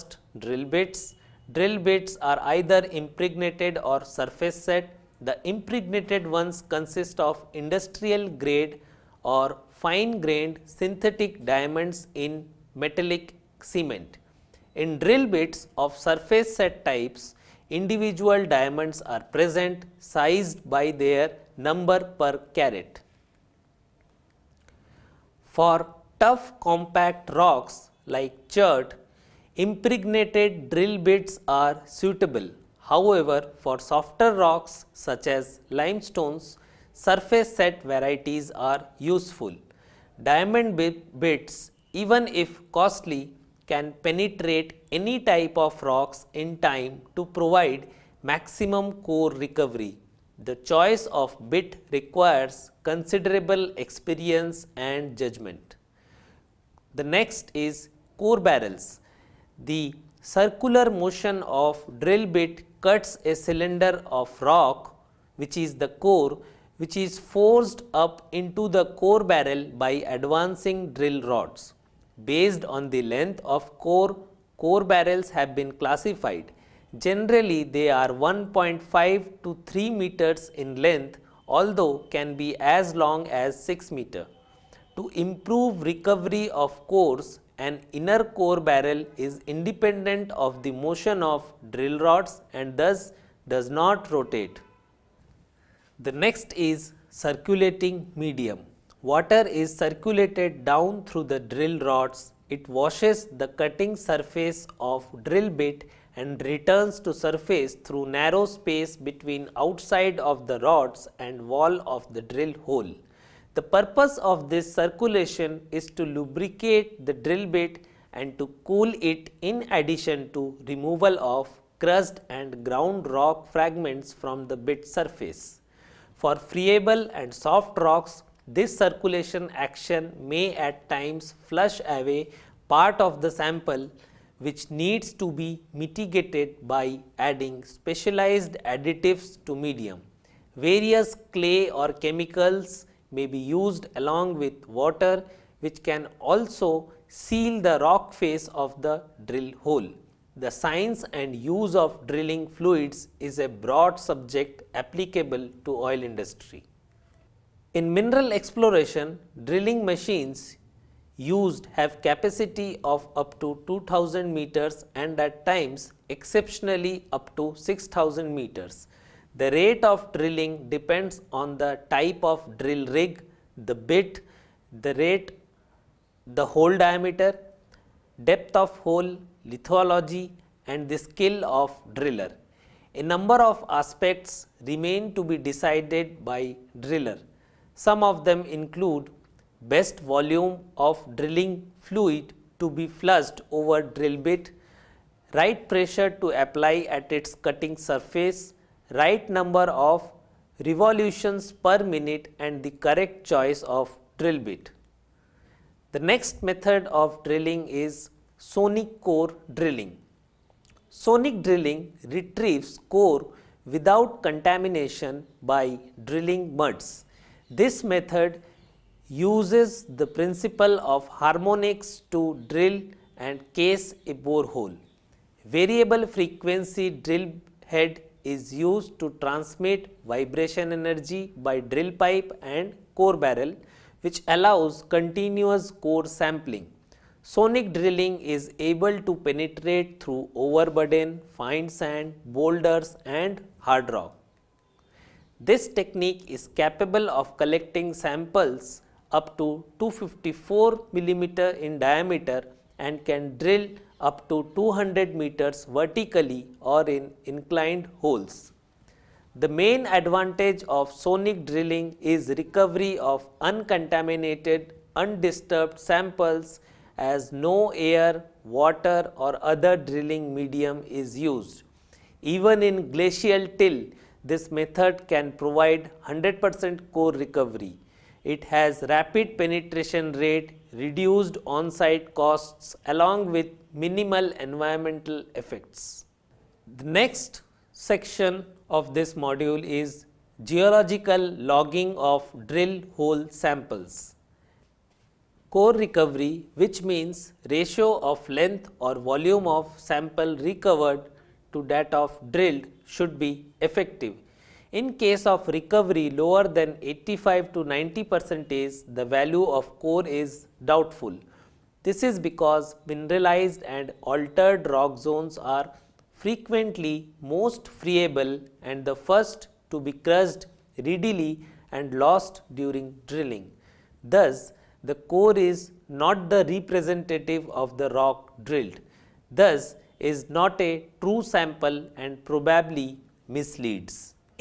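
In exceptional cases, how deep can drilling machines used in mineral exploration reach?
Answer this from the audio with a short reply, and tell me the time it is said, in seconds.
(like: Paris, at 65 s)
6000 meters, at 167 s.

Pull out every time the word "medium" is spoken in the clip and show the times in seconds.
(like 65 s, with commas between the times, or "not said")
98 s, 139 s, 270 s.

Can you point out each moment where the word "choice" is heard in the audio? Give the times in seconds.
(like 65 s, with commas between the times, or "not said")
50 s, 203 s.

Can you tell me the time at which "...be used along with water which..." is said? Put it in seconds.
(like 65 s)
143 s.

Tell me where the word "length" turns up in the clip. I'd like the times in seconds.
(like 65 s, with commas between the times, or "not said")
73 s, 80 s, 298 s.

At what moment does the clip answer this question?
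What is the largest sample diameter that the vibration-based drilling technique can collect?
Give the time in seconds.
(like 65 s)
249 s.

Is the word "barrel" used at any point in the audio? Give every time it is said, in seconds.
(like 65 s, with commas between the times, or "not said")
58 s, 69 s, 74 s, 88 s, 233 s.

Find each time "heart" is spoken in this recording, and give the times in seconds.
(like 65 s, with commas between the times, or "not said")
not said.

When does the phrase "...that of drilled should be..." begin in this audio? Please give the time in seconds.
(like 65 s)
301 s.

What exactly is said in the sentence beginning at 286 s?
The next section of this module is geological logging of drill hole samples.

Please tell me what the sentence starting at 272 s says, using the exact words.
Even in glacial till, this method can provide 100% core recovery.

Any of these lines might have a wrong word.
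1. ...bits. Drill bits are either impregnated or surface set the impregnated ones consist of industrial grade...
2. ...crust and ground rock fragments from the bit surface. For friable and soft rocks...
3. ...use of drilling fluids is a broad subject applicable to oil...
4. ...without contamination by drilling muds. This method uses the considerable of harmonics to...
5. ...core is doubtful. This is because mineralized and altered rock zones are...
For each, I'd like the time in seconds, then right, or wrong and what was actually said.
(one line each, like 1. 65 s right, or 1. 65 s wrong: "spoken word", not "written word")
1. 0 s right
2. 121 s right
3. 151 s right
4. 213 s wrong: "principle", not "considerable"
5. 309 s right.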